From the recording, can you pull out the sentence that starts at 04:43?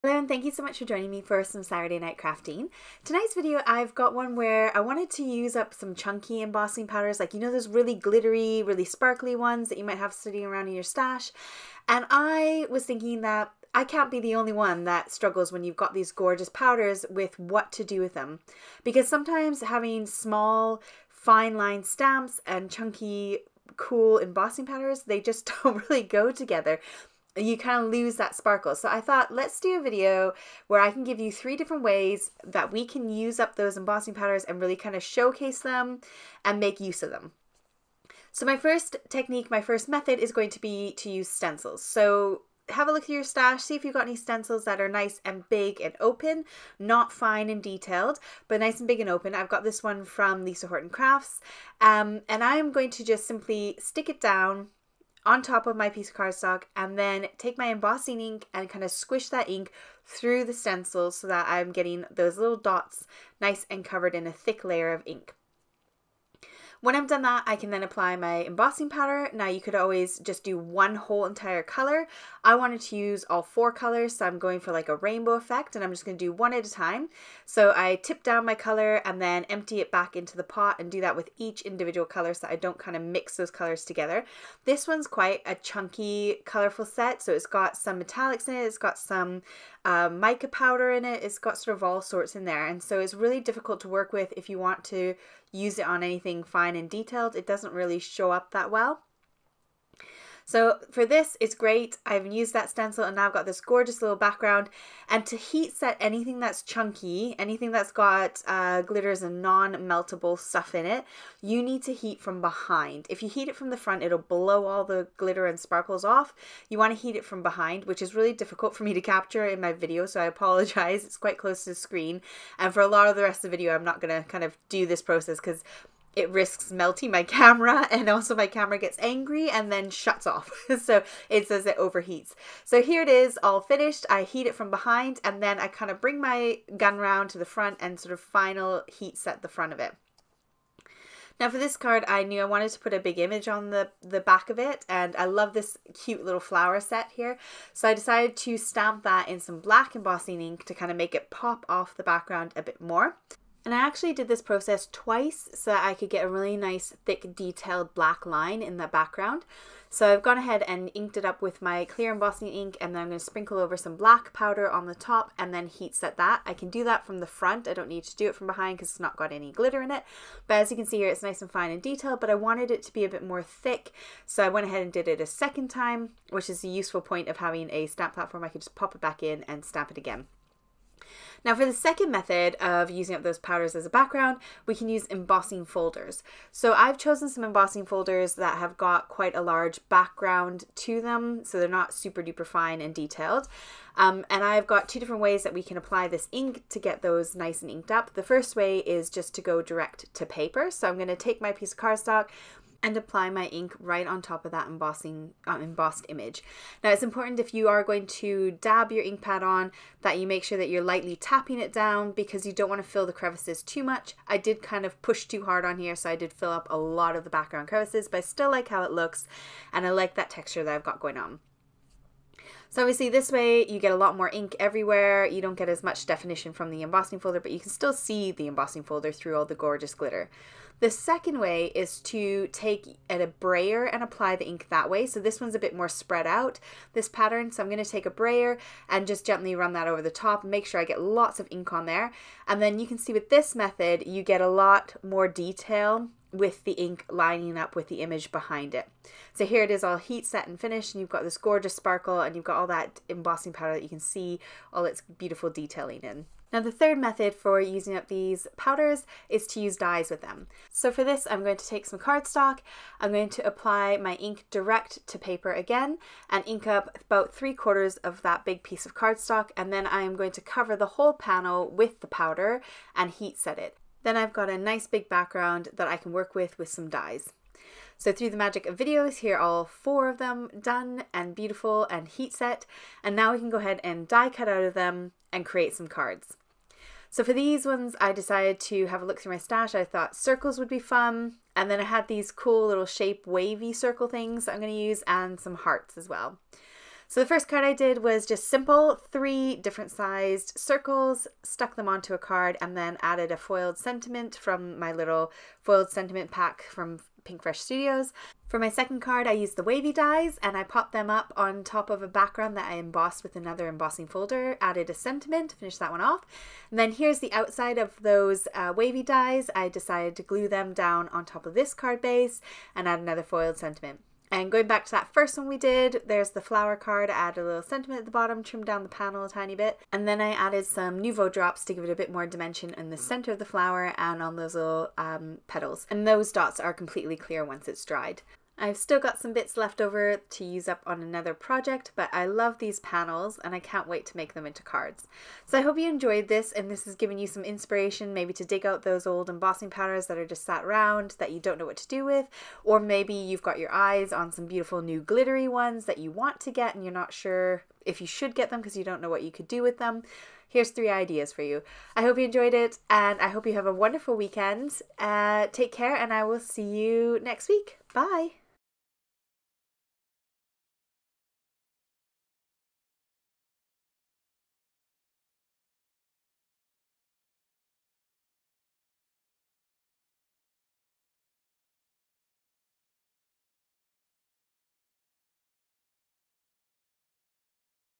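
And now we can go ahead and die cut out of them and create some cards.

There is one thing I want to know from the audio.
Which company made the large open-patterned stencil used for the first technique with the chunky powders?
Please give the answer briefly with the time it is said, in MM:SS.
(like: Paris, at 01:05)
Lisa Horton Crafts, at 00:50.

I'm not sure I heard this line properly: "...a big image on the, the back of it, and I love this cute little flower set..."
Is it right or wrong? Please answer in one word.
right.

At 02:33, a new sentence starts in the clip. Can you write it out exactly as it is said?
And I actually did this process twice so that I could get a really nice thick detailed black line in the background.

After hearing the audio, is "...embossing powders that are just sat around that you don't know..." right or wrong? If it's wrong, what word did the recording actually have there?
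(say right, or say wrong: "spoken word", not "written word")
right.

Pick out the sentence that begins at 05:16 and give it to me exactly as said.
And then here's the outside of those uh, wavy dies.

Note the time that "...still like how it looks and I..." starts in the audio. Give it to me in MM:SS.
03:38.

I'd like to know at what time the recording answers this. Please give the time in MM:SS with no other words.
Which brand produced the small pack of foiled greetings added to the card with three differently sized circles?
05:07.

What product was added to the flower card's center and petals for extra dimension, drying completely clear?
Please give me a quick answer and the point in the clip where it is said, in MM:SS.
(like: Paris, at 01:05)
Nuvo drops, at 05:31.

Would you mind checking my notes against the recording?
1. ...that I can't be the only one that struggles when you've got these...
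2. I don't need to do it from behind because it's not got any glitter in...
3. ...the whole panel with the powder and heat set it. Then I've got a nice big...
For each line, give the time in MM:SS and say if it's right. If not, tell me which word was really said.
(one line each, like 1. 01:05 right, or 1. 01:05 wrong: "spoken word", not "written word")
1. 00:13 right
2. 02:47 right
3. 04:30 right.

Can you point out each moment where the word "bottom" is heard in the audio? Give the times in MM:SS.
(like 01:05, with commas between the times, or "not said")
05:28.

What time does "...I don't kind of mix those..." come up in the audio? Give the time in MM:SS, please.
01:22.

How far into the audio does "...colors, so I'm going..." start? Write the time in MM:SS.
01:13.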